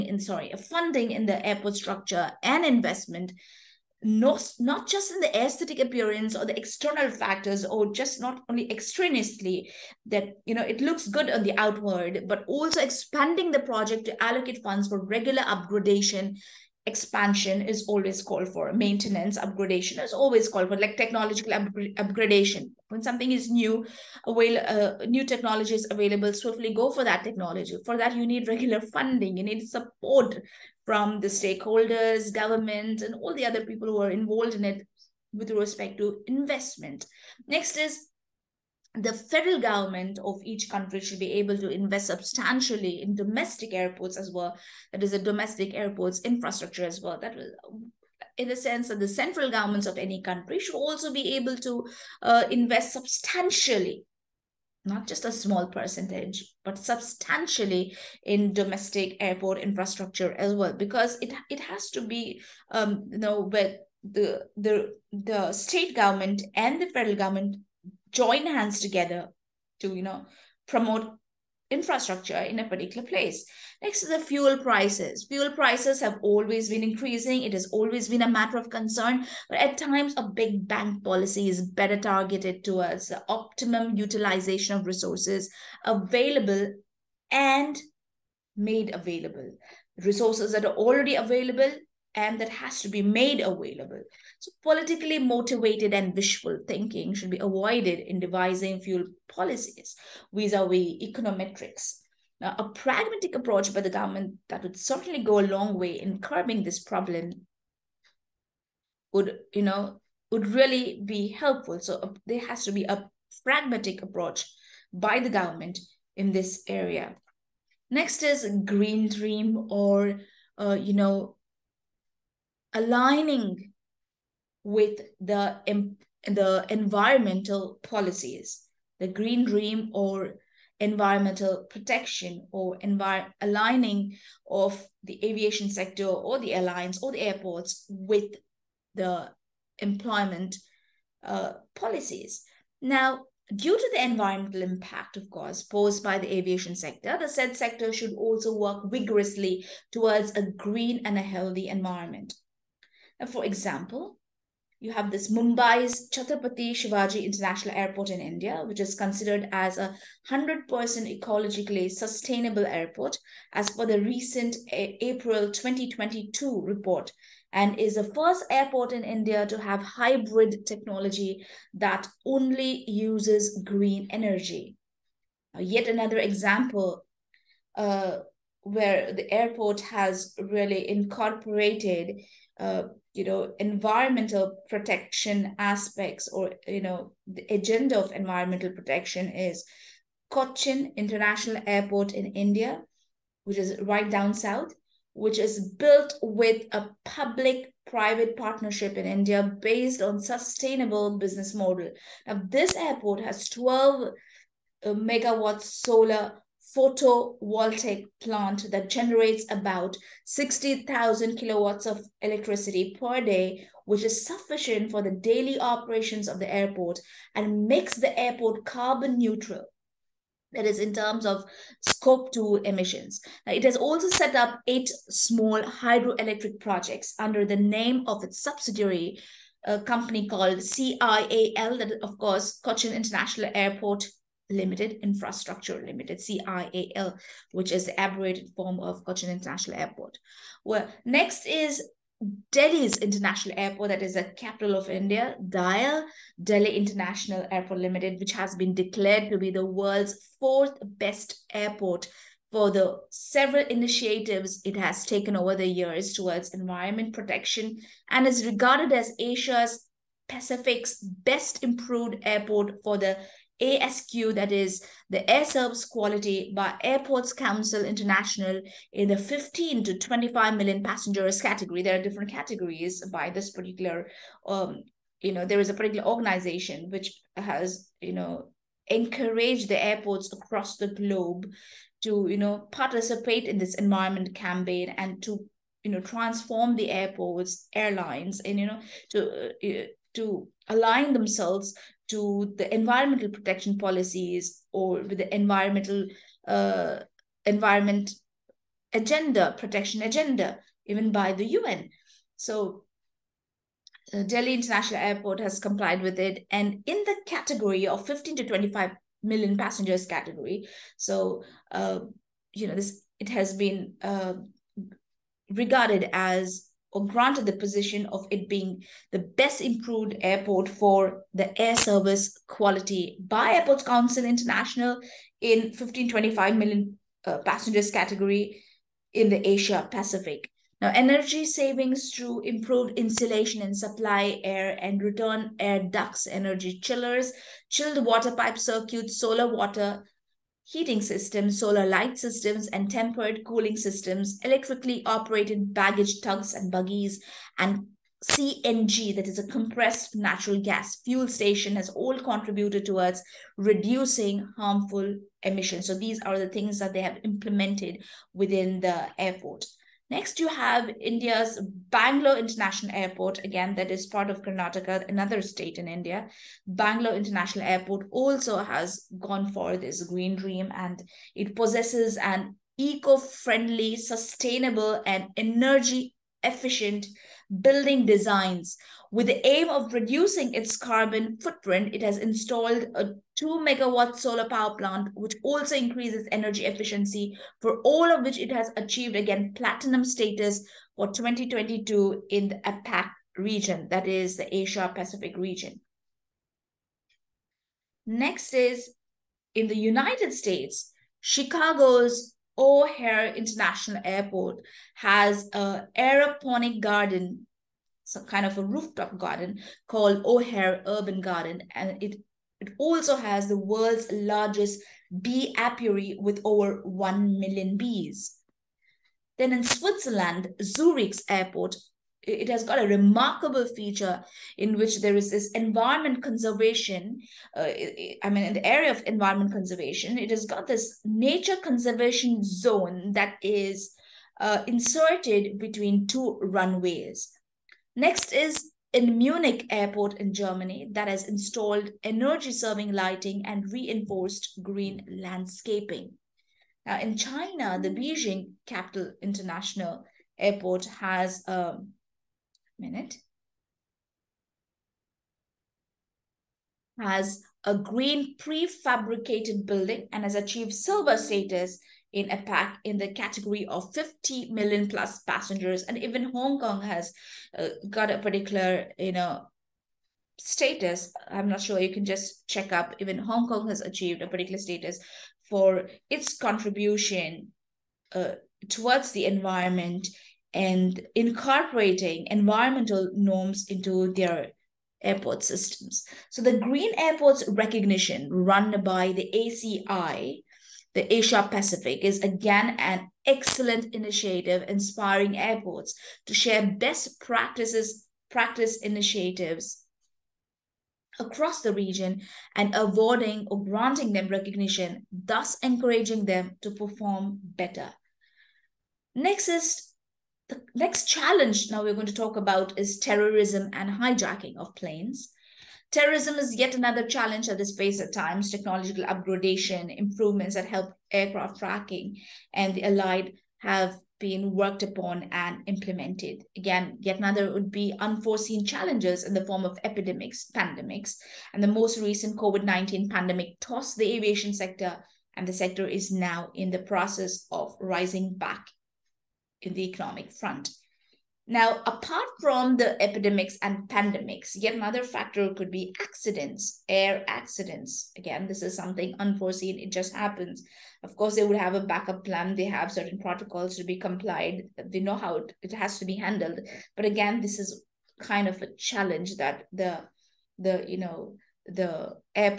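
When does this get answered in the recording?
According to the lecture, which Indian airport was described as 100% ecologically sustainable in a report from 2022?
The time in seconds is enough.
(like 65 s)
156 s.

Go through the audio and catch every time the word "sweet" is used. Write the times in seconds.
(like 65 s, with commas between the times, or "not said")
not said.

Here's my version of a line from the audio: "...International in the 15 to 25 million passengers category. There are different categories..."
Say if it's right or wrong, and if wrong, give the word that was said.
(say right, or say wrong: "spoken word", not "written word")
right.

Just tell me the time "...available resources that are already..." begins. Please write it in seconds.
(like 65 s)
88 s.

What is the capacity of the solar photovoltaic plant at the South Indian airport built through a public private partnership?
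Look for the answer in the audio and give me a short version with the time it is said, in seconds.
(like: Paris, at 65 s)
12 megawatts, at 203 s.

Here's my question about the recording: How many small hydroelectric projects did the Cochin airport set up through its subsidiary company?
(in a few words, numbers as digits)
8.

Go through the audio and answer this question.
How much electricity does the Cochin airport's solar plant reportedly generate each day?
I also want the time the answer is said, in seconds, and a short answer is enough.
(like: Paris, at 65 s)
60,000 kilowatts, at 210 s.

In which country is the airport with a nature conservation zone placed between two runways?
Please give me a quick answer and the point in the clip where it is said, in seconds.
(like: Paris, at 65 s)
Switzerland, at 419 s.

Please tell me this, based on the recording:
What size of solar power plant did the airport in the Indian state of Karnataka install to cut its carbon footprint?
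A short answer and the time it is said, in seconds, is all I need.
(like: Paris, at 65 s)
2 megawatt, at 383 s.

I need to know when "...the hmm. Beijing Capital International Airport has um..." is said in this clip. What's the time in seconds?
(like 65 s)
447 s.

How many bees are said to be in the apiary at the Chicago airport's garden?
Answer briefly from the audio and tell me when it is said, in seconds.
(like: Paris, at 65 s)
Over 1 million, at 416 s.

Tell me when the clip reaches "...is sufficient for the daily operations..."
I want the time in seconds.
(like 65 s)
214 s.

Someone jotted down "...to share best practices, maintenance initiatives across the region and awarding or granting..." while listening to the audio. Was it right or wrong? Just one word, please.
wrong.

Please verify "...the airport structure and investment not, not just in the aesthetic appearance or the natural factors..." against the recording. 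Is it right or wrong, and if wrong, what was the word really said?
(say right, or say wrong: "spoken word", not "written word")
wrong: "external", not "natural".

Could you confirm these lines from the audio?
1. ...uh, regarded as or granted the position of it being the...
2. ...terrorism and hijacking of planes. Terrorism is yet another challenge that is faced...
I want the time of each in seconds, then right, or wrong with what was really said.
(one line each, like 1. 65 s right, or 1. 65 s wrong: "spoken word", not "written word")
1. 314 s right
2. 512 s right.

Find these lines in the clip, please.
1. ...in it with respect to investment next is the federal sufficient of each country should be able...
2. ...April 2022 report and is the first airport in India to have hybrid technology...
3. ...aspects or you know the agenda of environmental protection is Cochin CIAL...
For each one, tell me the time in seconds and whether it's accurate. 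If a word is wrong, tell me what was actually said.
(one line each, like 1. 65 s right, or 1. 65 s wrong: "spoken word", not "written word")
1. 34 s wrong: "government", not "sufficient"
2. 164 s right
3. 185 s wrong: "International", not "CIAL".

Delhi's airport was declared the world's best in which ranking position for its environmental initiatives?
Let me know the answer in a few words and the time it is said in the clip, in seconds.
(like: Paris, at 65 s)
Fourth, at 250 s.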